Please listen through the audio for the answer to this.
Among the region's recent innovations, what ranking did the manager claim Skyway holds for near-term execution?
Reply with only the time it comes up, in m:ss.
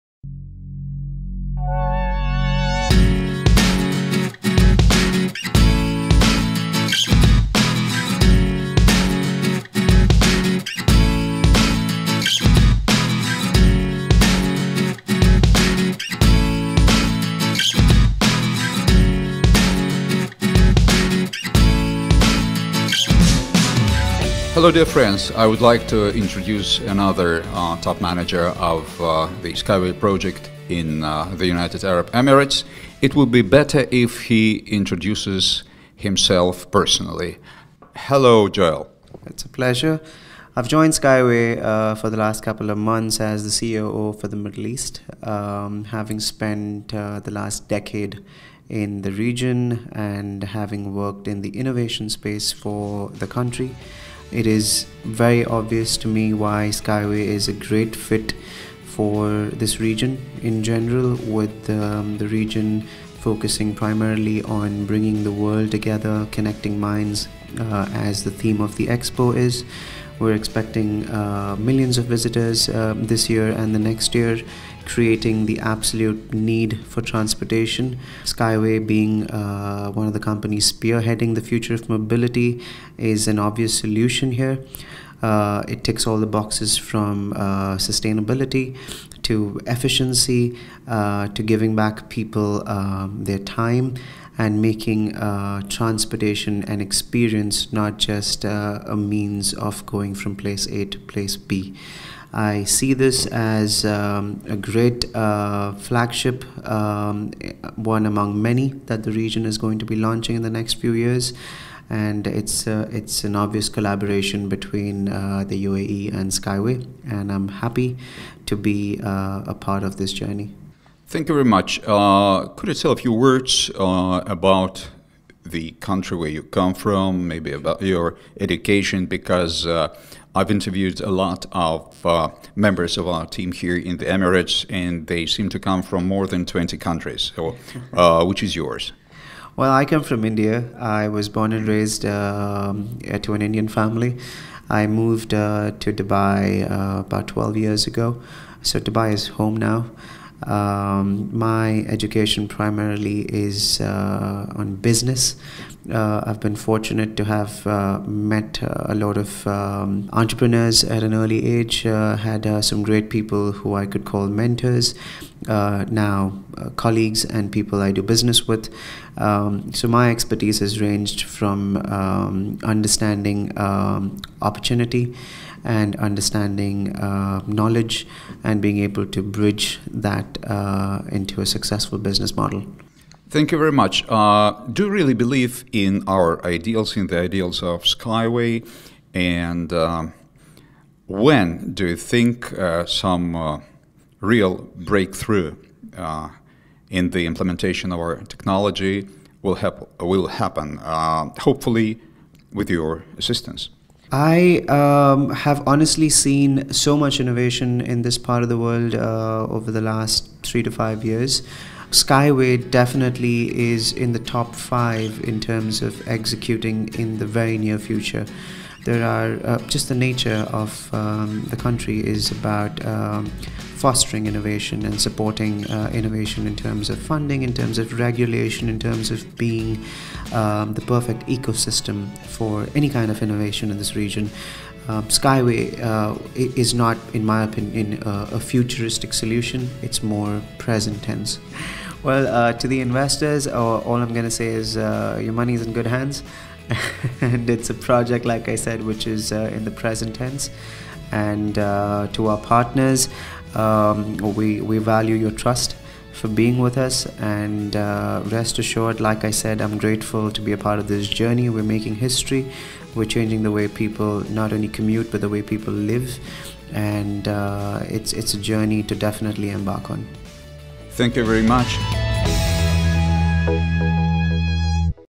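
3:34.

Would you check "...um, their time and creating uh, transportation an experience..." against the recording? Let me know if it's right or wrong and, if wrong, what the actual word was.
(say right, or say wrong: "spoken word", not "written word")
wrong: "making", not "creating".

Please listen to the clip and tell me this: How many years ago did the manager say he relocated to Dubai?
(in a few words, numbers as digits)
12.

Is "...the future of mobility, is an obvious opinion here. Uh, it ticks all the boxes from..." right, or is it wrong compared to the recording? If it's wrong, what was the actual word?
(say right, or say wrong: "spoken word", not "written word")
wrong: "solution", not "opinion".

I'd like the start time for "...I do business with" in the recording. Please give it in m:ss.
2:47.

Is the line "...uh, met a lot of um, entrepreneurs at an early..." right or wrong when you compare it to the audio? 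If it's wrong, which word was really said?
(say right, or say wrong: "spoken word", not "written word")
right.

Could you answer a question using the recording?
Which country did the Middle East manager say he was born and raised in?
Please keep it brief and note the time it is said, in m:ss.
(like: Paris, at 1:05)
India, at 2:20.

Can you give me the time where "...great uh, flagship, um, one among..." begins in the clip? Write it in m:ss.
1:44.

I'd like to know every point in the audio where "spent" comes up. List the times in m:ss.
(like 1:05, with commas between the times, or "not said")
0:46.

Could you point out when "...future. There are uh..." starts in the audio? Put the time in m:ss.
3:37.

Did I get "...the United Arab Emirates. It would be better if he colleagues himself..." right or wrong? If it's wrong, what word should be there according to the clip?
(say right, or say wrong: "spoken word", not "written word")
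wrong: "introduces", not "colleagues".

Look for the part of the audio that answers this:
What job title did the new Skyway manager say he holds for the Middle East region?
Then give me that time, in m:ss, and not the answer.
0:43.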